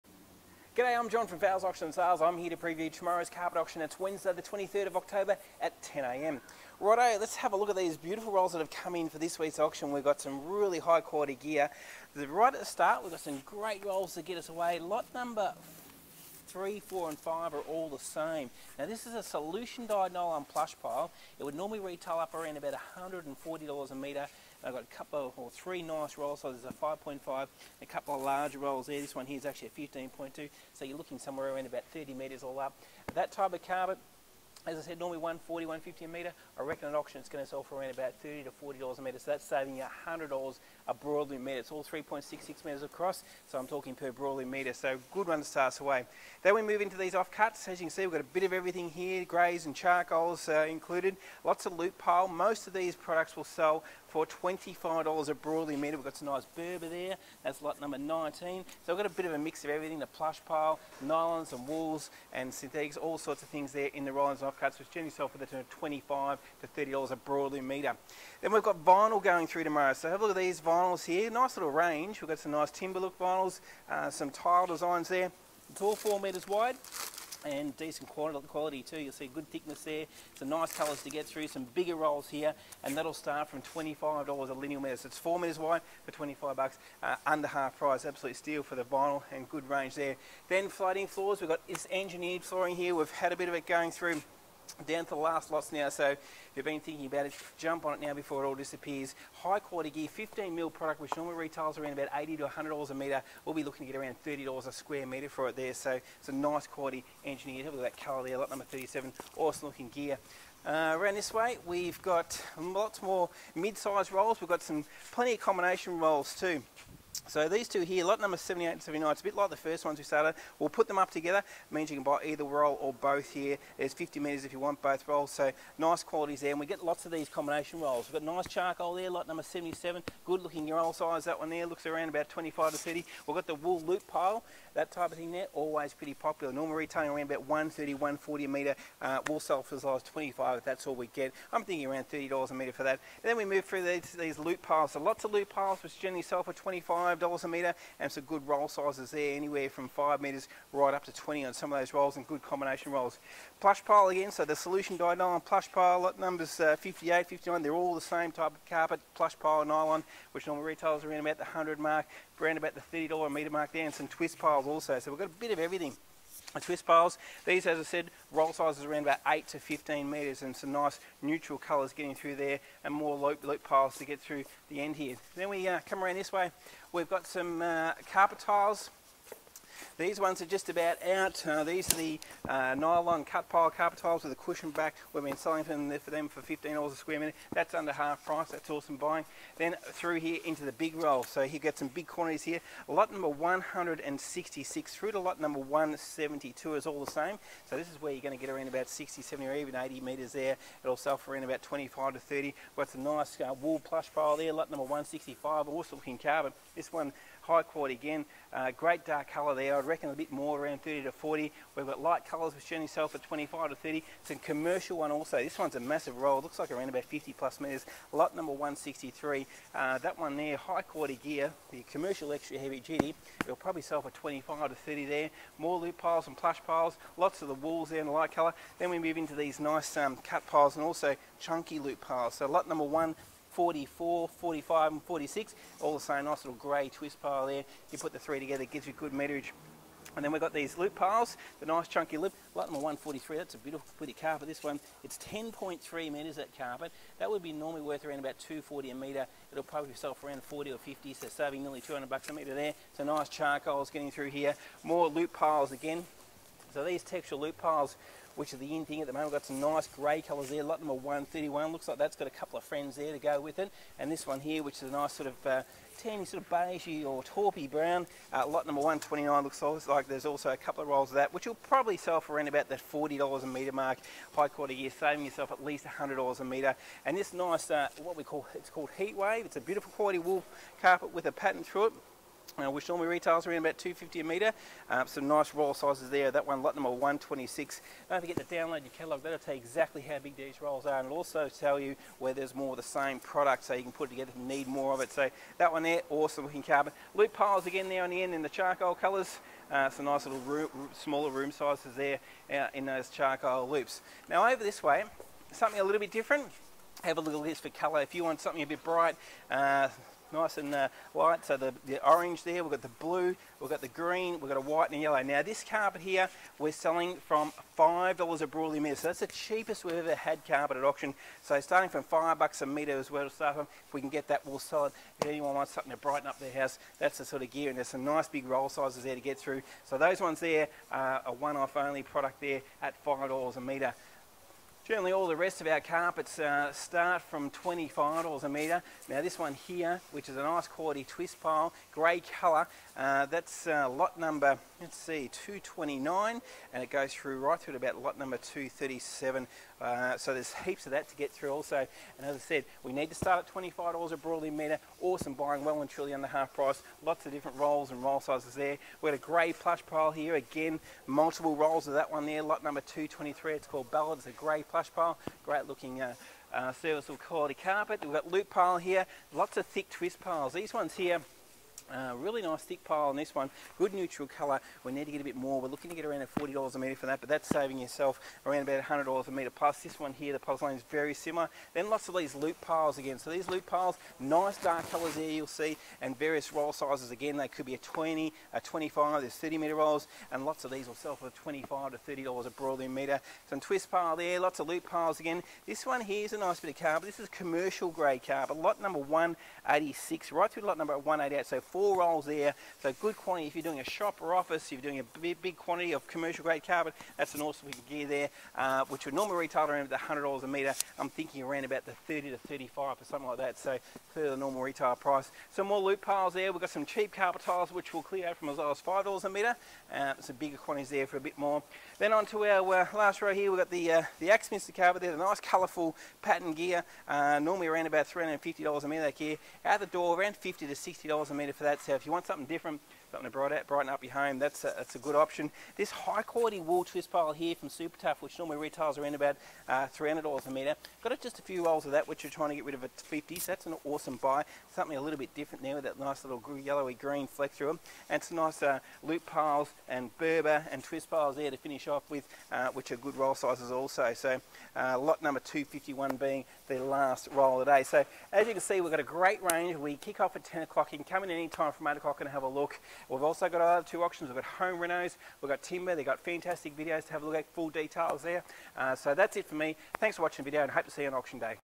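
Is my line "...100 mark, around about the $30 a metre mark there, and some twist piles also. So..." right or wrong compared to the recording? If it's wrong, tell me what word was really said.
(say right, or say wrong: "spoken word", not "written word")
right.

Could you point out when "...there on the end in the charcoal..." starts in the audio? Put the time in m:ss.
4:57.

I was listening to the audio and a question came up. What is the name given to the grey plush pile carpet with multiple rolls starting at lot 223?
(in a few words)
Ballad.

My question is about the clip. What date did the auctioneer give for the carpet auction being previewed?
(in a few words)
Wednesday, 23rd of October.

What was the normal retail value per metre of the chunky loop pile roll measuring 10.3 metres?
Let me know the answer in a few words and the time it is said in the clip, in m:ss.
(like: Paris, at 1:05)
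$240, at 4:08.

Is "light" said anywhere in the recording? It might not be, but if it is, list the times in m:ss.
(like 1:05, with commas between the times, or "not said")
3:31, 3:48, 5:11.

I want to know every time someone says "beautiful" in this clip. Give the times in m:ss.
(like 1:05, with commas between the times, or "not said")
0:07, 4:03, 4:39.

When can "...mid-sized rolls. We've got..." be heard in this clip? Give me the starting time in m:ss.
1:53.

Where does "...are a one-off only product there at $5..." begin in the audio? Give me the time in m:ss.
5:30.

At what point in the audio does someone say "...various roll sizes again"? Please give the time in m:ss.
6:26.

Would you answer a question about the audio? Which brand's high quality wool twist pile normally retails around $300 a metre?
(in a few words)
Super Tough.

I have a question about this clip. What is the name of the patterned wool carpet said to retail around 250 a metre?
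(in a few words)
Heat wave.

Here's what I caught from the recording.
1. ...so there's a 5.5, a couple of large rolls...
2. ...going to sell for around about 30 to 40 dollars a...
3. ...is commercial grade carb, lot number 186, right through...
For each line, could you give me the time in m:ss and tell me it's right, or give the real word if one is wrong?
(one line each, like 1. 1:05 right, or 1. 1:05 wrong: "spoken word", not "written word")
1. 0:26 right
2. 0:37 right
3. 6:37 right.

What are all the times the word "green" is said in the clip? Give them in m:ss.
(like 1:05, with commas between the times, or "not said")
5:13, 7:26.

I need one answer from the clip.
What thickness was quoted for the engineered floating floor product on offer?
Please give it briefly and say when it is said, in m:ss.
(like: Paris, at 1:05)
15 mil, at 1:40.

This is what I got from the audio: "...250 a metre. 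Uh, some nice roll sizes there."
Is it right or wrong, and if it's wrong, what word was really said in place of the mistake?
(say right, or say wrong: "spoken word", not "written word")
right.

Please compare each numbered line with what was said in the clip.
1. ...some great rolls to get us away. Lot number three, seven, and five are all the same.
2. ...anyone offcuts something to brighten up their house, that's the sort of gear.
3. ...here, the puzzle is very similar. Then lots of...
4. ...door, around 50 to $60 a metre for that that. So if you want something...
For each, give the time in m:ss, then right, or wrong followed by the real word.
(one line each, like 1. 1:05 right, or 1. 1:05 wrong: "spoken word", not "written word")
1. 0:13 wrong: "four", not "seven"
2. 5:25 wrong: "wants", not "offcuts"
3. 6:20 right
4. 7:09 right.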